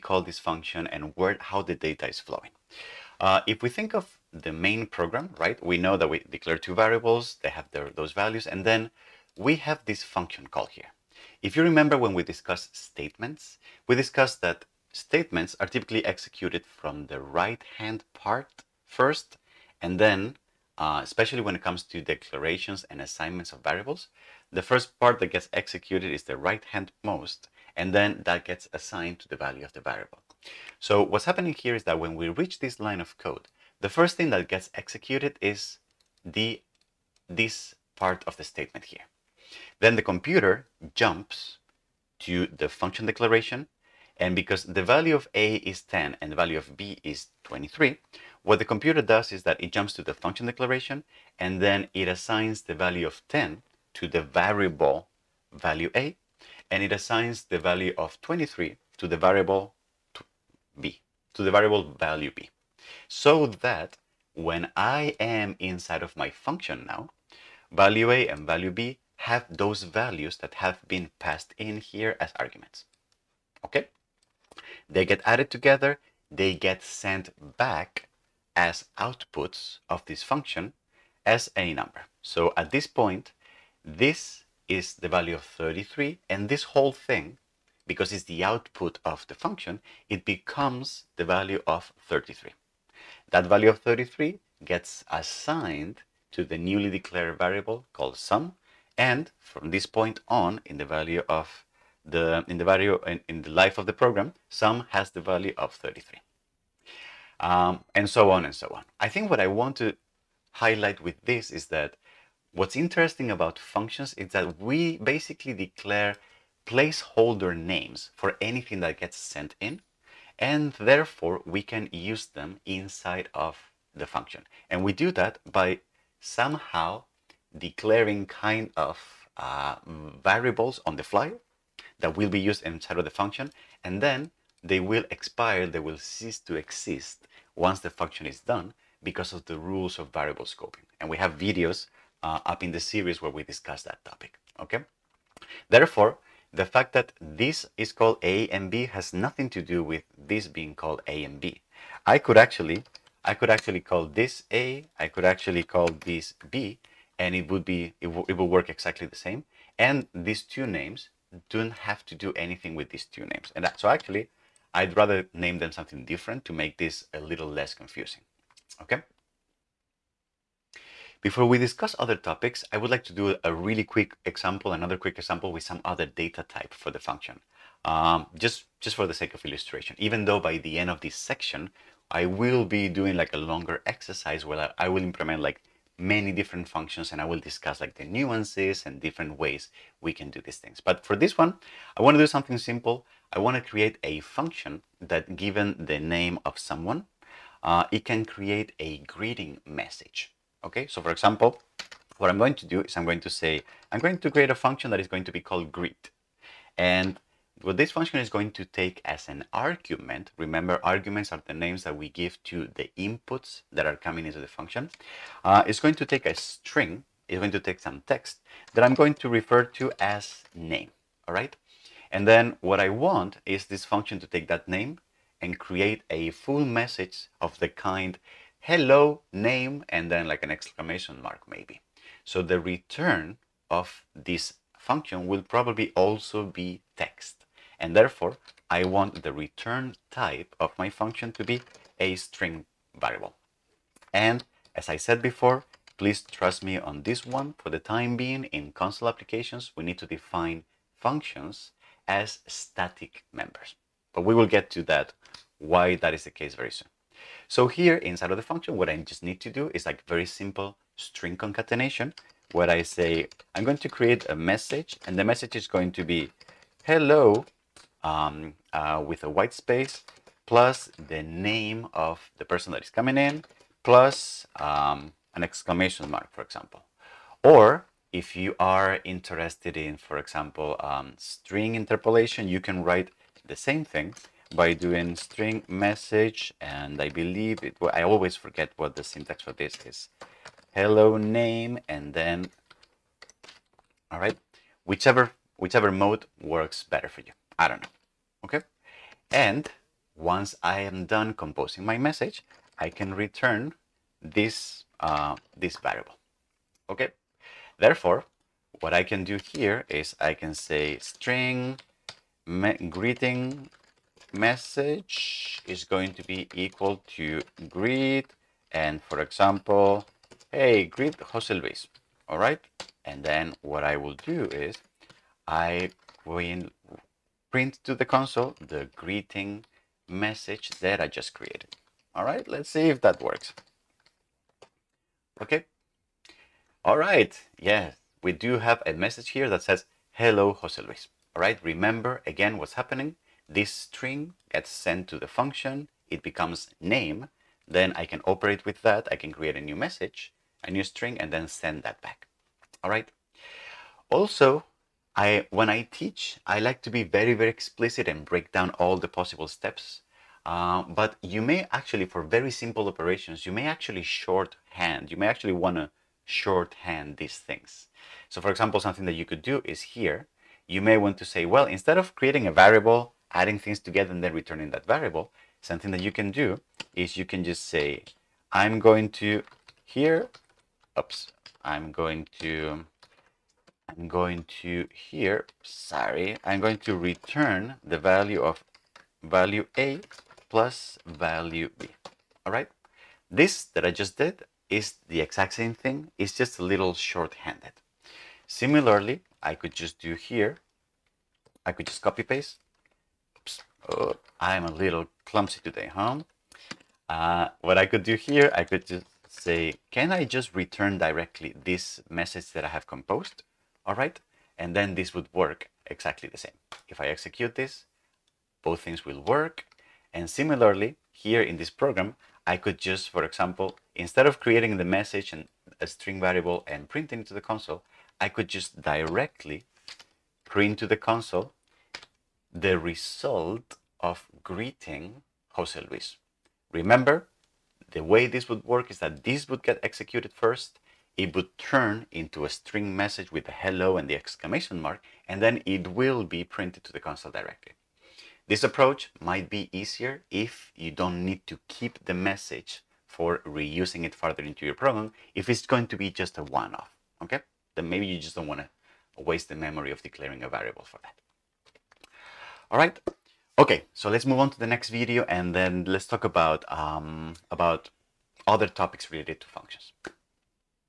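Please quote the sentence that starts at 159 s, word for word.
And these two names don't have to do anything with these two names.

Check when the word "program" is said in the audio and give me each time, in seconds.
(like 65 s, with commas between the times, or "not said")
4 s, 103 s, 421 s, 454 s.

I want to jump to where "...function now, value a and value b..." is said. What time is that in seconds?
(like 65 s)
66 s.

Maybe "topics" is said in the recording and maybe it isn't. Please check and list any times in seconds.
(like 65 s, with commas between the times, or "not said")
144 s, 172 s, 468 s.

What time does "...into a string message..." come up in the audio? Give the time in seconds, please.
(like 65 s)
442 s.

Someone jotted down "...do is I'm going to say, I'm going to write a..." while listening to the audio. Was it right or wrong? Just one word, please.
wrong.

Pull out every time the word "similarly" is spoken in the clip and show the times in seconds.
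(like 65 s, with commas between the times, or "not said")
398 s, 420 s.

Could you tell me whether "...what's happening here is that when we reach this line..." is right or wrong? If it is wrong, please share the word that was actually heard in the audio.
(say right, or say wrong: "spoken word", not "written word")
right.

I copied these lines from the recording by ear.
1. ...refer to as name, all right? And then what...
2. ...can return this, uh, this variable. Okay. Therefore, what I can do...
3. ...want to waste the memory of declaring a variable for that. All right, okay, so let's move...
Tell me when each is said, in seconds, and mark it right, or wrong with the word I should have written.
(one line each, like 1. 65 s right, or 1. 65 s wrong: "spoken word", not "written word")
1. 219 s right
2. 302 s right
3. 458 s right.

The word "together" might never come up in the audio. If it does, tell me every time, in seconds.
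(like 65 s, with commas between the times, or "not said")
75 s, 373 s.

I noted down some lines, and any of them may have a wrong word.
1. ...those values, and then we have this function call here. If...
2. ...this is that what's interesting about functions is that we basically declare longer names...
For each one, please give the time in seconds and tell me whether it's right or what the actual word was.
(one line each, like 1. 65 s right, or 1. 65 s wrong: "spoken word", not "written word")
1. 7 s right
2. 111 s wrong: "placeholder", not "longer".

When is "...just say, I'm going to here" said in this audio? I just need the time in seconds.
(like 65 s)
377 s.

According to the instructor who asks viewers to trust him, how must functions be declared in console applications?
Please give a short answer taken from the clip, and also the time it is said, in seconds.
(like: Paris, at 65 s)
static members, at 252 s.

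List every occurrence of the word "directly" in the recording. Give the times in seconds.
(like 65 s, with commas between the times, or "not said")
410 s, 428 s, 447 s.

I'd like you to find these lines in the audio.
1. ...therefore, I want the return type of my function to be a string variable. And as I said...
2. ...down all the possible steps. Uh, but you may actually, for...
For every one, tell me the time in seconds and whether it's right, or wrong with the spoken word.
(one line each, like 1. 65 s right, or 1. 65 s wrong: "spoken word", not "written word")
1. 237 s right
2. 358 s right.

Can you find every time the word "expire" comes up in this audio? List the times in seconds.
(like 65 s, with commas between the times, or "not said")
135 s.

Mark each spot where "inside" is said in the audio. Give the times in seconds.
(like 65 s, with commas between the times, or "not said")
65 s, 122 s, 132 s, 257 s.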